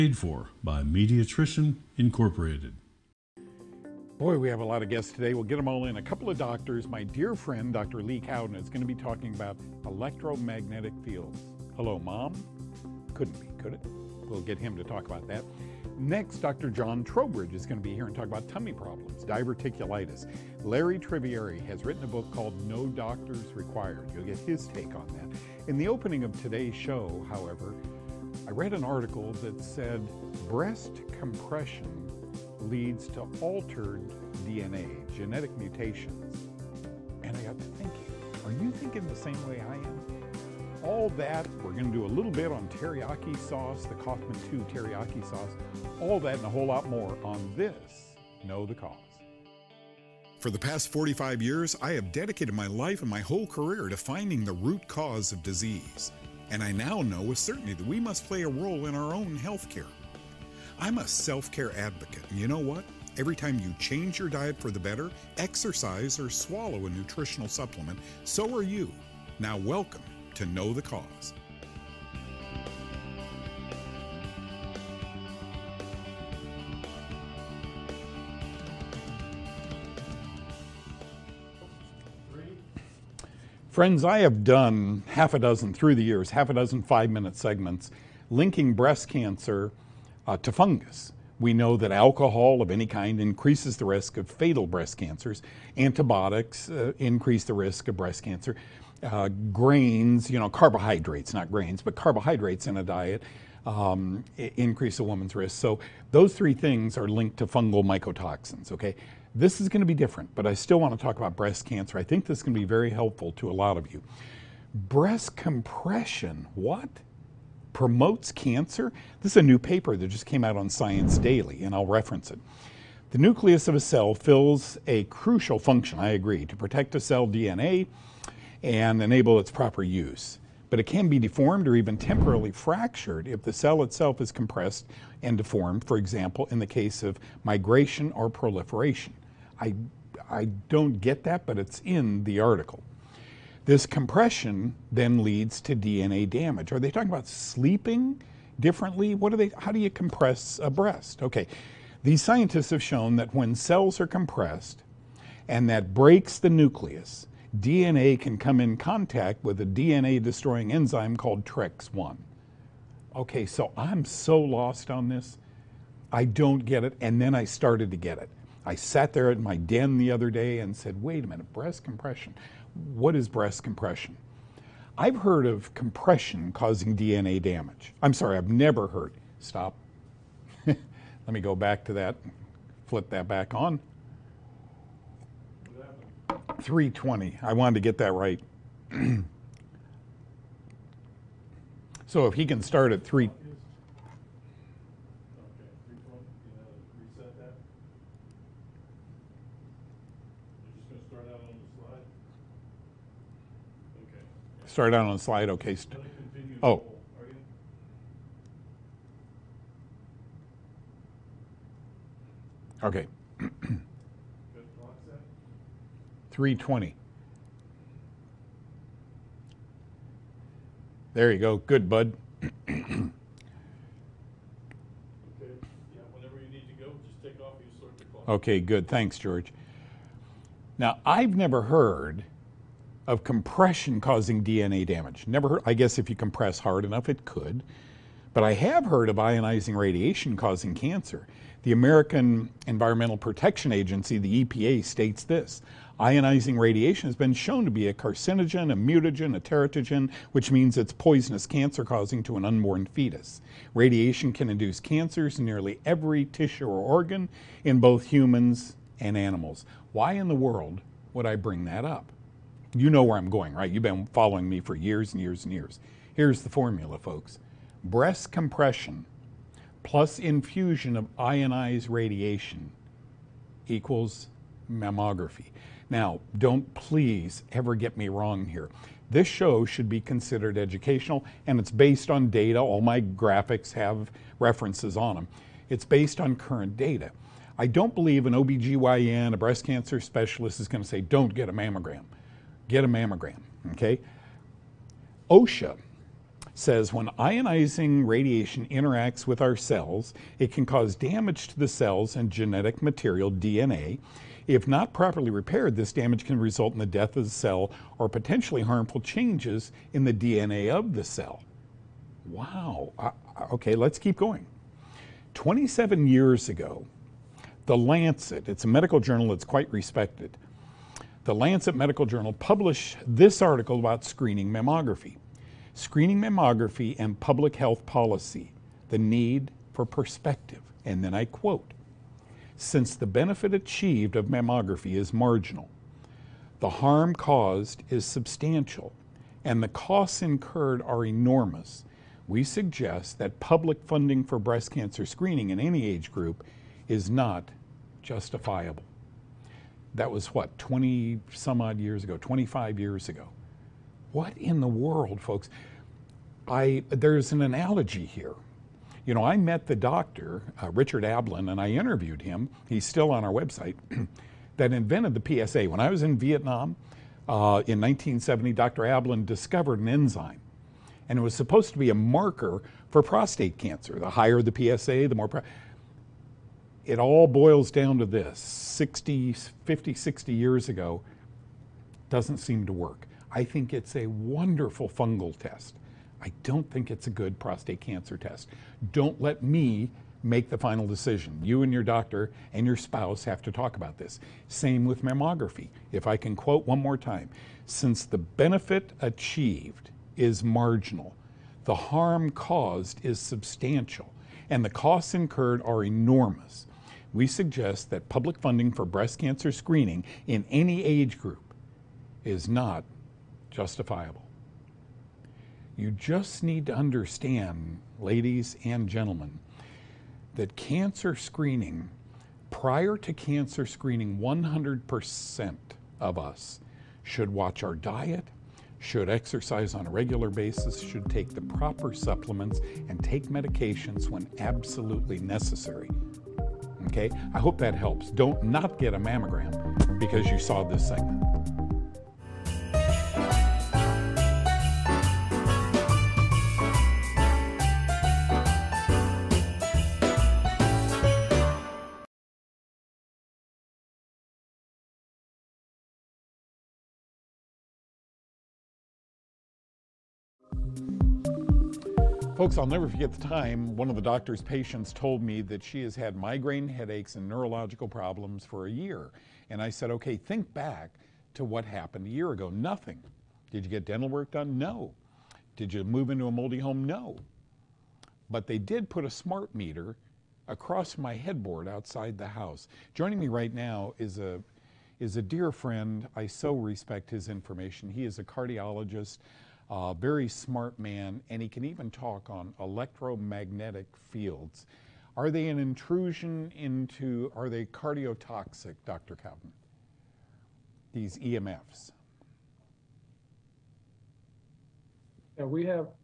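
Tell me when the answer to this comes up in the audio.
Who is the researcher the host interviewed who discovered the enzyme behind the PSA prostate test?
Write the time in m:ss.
6:00.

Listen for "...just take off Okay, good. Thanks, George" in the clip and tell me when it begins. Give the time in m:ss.
3:47.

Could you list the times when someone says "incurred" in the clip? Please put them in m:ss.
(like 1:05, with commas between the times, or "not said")
5:40, 6:45.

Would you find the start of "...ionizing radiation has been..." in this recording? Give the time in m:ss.
4:06.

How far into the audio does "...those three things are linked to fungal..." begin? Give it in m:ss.
1:46.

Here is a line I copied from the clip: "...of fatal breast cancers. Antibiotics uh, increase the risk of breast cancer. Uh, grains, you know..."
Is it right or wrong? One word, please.
right.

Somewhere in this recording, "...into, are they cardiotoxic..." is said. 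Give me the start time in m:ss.
8:16.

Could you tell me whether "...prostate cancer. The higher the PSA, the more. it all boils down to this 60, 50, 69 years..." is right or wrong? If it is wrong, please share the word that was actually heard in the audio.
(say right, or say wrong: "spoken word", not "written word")
wrong: "60", not "69".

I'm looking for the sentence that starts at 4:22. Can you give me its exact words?
You know where I'm going, right?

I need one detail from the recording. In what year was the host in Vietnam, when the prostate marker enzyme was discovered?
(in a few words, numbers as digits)
1970.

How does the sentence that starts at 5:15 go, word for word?
27 years ago, The Lancet, it's a medical journal that's quite respected, The Lancet Medical Journal published this article about screening mammography.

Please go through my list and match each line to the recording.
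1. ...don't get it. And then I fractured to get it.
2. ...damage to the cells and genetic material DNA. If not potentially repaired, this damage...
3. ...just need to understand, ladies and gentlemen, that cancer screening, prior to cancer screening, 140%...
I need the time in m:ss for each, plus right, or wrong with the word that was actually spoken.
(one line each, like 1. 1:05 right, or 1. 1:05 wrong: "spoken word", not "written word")
1. 2:46 wrong: "started", not "fractured"
2. 5:00 wrong: "properly", not "potentially"
3. 6:55 wrong: "100", not "140".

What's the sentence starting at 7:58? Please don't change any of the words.
But they did put a smart meter across my headboard outside the house.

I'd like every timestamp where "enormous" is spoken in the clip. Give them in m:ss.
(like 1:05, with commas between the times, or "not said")
5:41, 6:45.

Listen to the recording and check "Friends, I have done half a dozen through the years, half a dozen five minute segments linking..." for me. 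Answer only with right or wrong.
right.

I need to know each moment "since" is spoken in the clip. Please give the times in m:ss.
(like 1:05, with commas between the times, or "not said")
5:32, 6:37.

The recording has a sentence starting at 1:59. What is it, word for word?
This is a new paper that just came out on Science Daily, and I'll reference it.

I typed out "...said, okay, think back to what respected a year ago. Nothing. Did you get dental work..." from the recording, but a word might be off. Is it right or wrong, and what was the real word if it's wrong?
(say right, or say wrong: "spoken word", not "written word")
wrong: "happened", not "respected".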